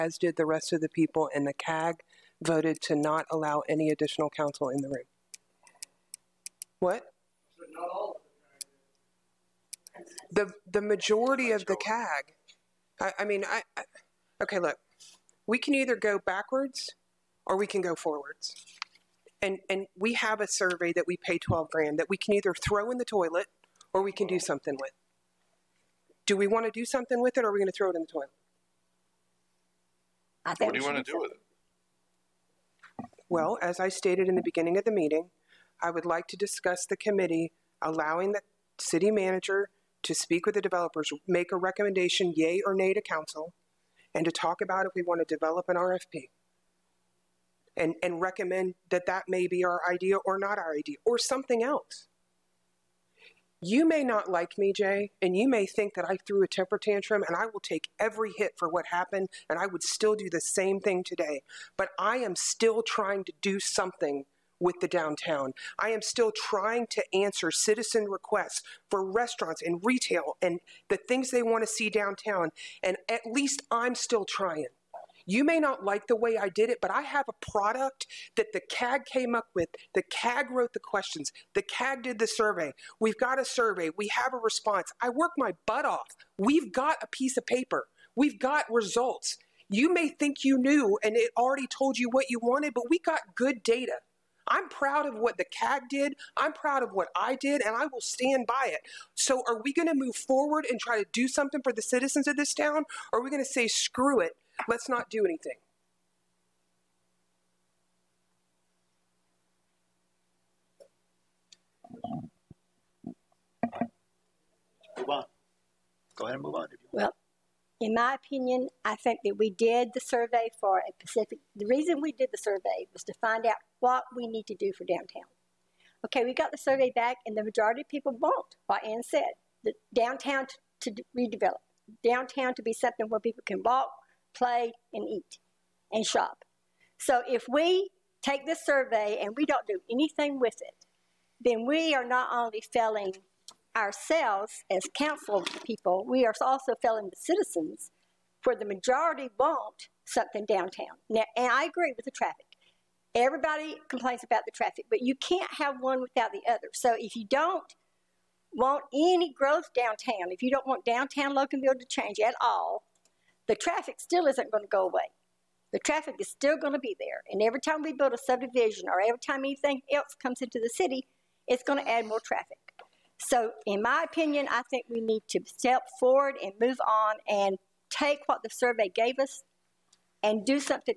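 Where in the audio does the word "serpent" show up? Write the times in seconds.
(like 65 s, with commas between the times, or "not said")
not said.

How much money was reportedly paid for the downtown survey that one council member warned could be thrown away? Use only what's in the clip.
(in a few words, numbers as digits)
$12,000.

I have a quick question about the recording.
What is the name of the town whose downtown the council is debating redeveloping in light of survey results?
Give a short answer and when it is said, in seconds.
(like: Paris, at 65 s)
Loganville, at 161 s.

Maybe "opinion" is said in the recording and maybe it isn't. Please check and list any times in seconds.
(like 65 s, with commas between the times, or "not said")
118 s, 174 s.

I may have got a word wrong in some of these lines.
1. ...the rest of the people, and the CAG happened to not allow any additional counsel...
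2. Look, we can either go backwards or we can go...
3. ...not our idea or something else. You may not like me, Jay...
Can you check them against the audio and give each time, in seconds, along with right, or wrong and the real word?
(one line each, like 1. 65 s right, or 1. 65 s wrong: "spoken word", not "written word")
1. 0 s wrong: "voted", not "happened"
2. 14 s right
3. 50 s right.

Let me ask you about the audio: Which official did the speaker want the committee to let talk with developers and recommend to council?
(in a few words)
City manager.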